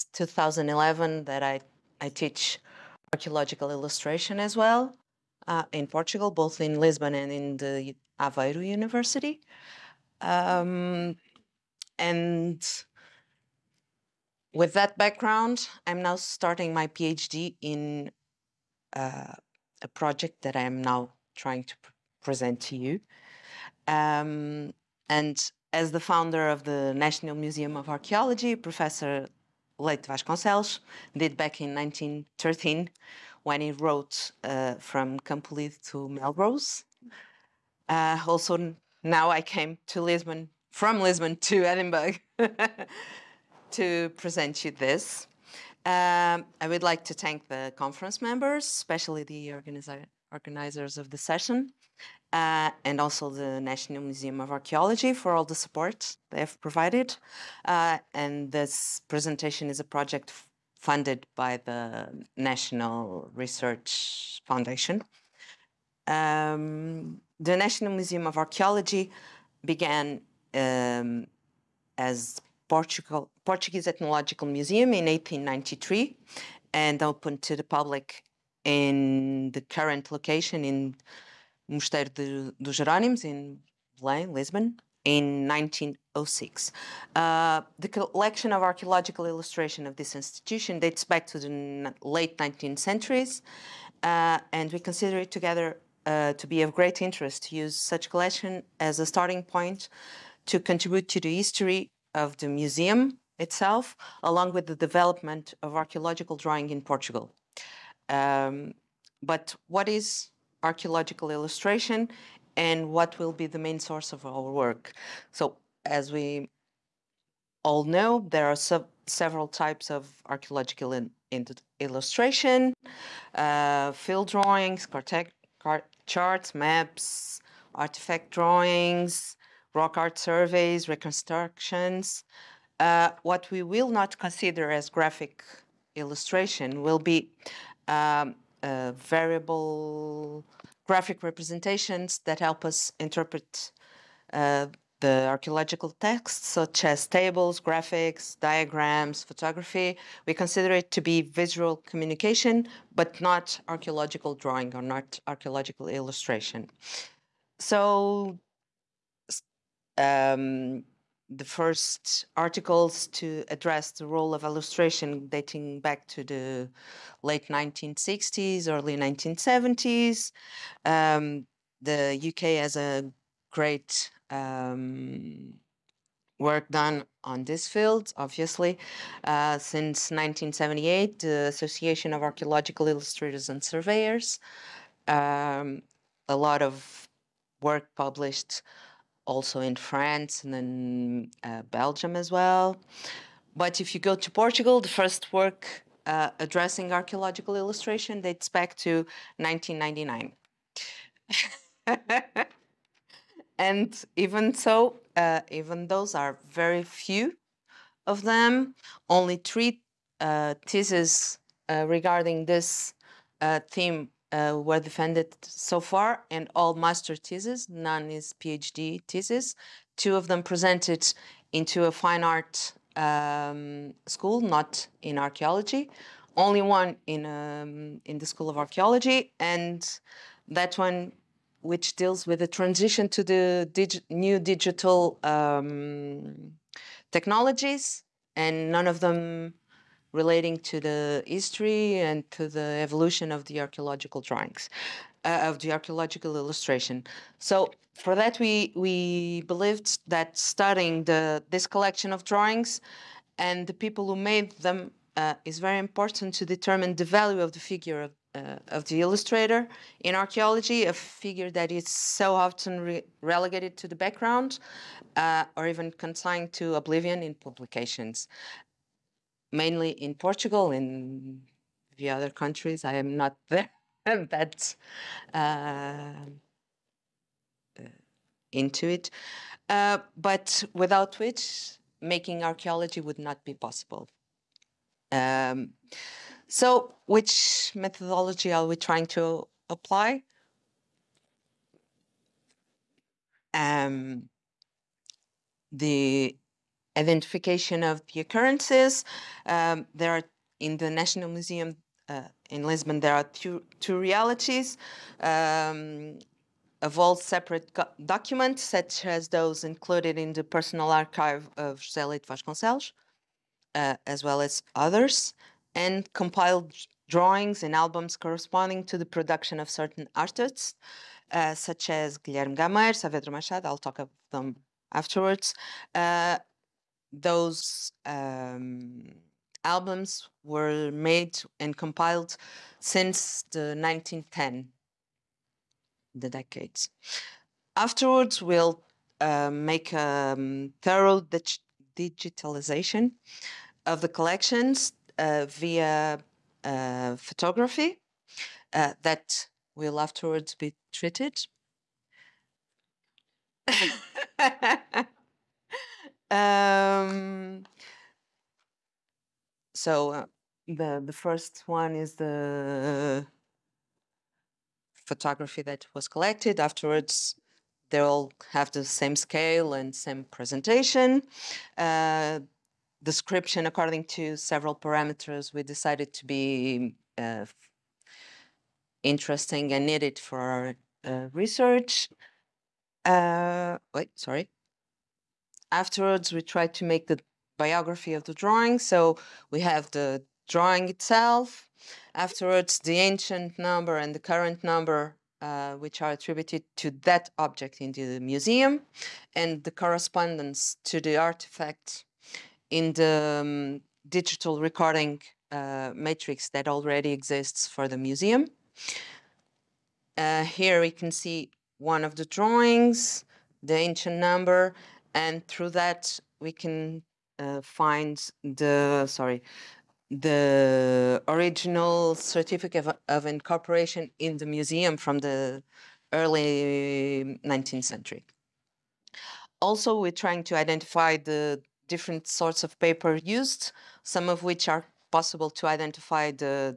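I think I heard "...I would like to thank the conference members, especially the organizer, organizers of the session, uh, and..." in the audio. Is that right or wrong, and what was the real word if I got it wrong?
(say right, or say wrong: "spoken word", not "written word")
right.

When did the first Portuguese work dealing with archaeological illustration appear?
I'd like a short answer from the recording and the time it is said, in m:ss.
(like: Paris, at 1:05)
1999, at 3:19.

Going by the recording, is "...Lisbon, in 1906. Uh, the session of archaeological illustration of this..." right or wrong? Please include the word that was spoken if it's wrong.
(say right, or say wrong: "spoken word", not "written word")
wrong: "collection", not "session".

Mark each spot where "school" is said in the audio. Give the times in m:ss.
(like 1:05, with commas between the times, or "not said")
3:44, 3:48.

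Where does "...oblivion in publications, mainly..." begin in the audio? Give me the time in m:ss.
4:26.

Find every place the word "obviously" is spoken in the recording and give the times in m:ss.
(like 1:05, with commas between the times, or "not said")
2:58.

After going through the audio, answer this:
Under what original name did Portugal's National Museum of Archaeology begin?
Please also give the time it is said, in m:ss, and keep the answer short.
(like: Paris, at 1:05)
Portuguese Ethnological Museum, at 1:13.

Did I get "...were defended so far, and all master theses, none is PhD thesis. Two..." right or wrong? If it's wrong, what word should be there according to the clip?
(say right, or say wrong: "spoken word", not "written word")
right.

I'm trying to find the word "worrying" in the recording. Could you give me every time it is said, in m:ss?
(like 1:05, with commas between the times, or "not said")
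not said.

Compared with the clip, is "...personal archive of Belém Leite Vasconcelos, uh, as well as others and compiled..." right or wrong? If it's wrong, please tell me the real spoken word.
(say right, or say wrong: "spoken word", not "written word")
wrong: "José", not "Belém".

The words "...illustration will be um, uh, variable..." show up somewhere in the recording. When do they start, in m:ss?
2:15.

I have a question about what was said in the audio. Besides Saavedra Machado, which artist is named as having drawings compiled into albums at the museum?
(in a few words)
Guilherme Gameiro.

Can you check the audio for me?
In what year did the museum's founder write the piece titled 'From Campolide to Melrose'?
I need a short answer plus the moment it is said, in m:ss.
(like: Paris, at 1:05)
1913, at 0:31.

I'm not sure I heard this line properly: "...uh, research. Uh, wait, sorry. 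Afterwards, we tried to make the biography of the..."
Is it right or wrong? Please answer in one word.
right.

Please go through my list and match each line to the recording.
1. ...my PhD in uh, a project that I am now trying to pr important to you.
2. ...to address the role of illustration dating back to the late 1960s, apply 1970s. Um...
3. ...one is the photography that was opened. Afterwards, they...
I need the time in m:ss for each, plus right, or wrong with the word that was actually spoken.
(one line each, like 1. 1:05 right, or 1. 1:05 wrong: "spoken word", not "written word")
1. 0:16 wrong: "present", not "important"
2. 2:43 wrong: "early", not "apply"
3. 6:01 wrong: "collected", not "opened".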